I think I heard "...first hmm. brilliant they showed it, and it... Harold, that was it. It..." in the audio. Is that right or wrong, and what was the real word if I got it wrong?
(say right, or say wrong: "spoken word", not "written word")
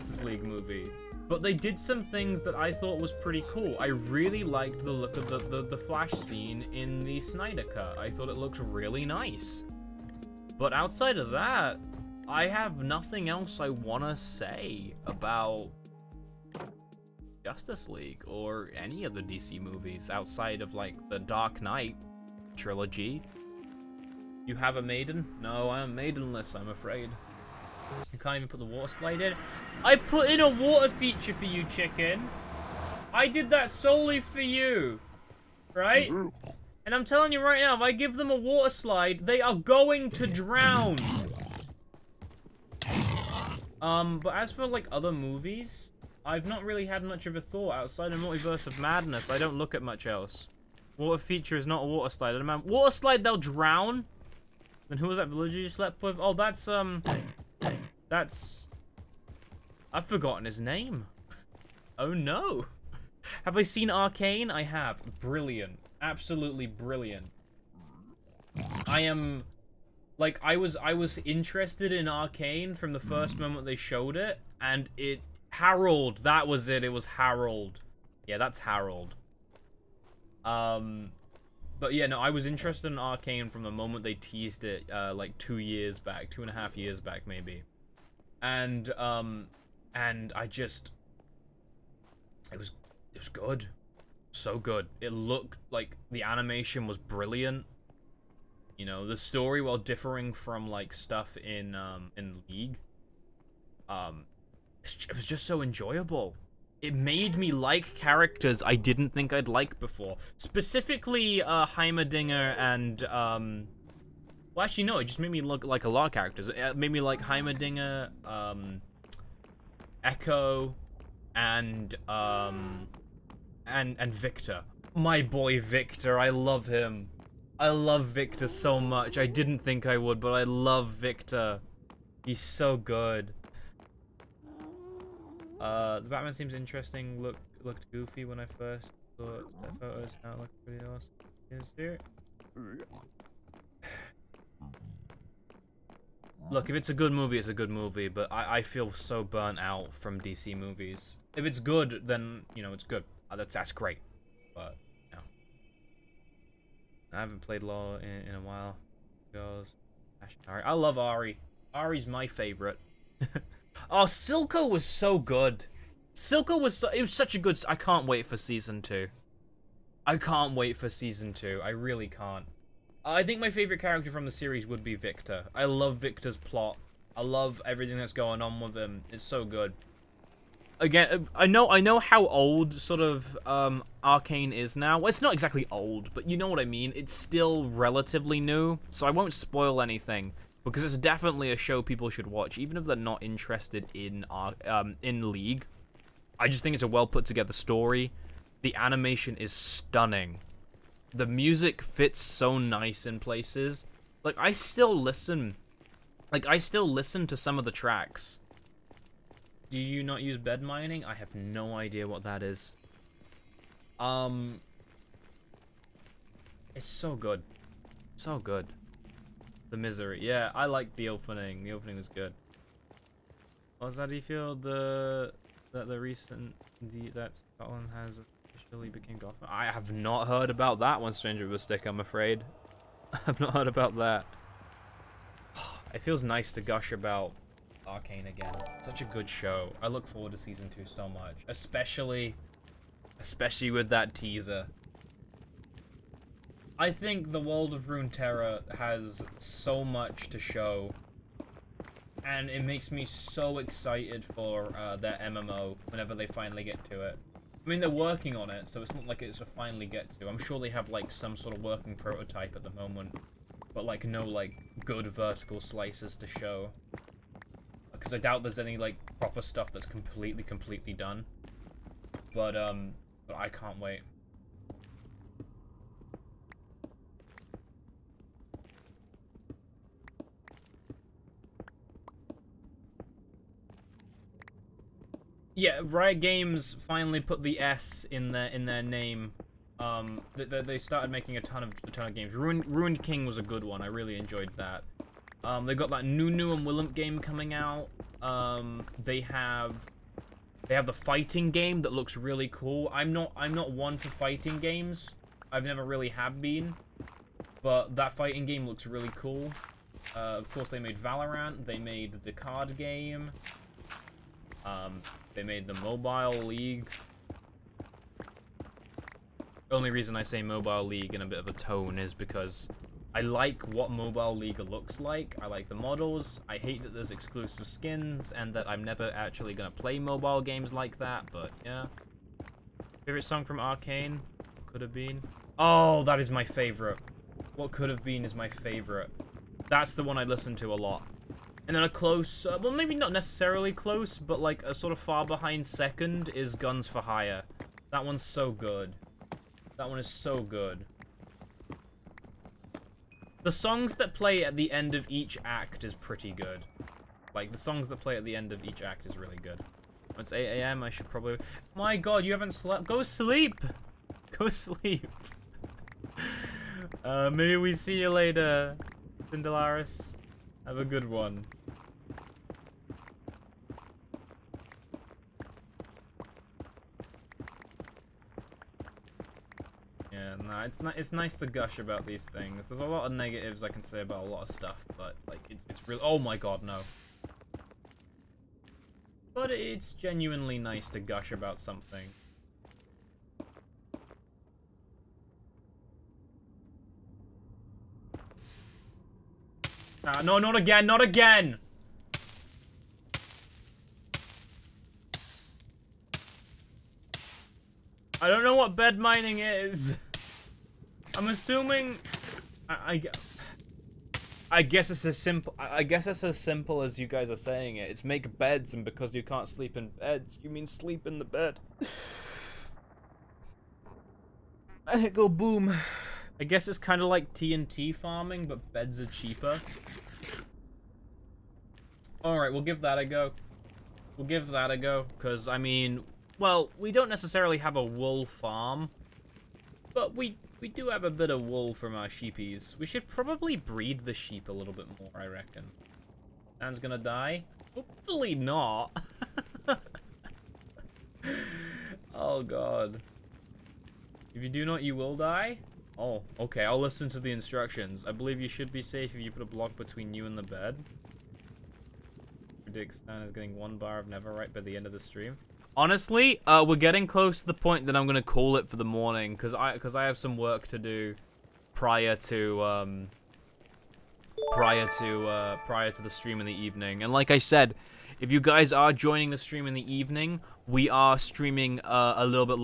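wrong: "moment", not "brilliant".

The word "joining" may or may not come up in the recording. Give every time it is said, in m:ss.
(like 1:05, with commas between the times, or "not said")
7:58.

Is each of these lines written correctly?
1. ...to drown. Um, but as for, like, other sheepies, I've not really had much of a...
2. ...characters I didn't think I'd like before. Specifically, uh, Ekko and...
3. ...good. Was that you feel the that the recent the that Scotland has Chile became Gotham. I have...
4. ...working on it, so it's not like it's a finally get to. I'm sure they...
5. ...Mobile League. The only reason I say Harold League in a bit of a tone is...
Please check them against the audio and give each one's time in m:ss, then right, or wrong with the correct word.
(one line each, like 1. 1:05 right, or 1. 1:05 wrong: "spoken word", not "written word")
1. 0:40 wrong: "movies", not "sheepies"
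2. 1:47 wrong: "Heimerdinger", not "Ekko"
3. 3:42 right
4. 4:17 right
5. 5:15 wrong: "Mobile", not "Harold".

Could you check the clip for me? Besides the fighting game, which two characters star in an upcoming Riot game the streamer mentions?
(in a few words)
Nunu and Willump.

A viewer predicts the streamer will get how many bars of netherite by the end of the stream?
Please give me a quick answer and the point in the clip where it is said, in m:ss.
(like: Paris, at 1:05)
1, at 7:43.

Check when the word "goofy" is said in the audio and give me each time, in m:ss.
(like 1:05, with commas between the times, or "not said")
2:17.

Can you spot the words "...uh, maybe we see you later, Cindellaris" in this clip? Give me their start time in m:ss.
6:07.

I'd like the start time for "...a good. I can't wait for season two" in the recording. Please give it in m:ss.
2:47.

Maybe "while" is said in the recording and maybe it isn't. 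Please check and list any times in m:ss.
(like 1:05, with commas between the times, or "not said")
1:39, 2:38.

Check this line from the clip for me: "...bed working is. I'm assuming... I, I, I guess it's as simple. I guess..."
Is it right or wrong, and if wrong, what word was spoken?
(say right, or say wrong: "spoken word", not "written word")
wrong: "mining", not "working".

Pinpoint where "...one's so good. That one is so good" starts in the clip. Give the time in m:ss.
5:48.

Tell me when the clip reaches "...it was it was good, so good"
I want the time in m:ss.
1:32.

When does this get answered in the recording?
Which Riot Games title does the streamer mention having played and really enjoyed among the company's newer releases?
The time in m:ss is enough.
4:52.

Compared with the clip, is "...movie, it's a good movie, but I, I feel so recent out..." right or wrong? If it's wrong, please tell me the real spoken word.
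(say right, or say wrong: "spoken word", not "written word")
wrong: "burnt", not "recent".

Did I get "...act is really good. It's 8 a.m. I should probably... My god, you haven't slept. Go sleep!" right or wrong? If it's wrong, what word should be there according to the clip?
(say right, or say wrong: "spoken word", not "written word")
right.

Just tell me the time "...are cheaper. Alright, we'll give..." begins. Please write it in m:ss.
7:08.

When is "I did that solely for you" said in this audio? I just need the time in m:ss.
0:33.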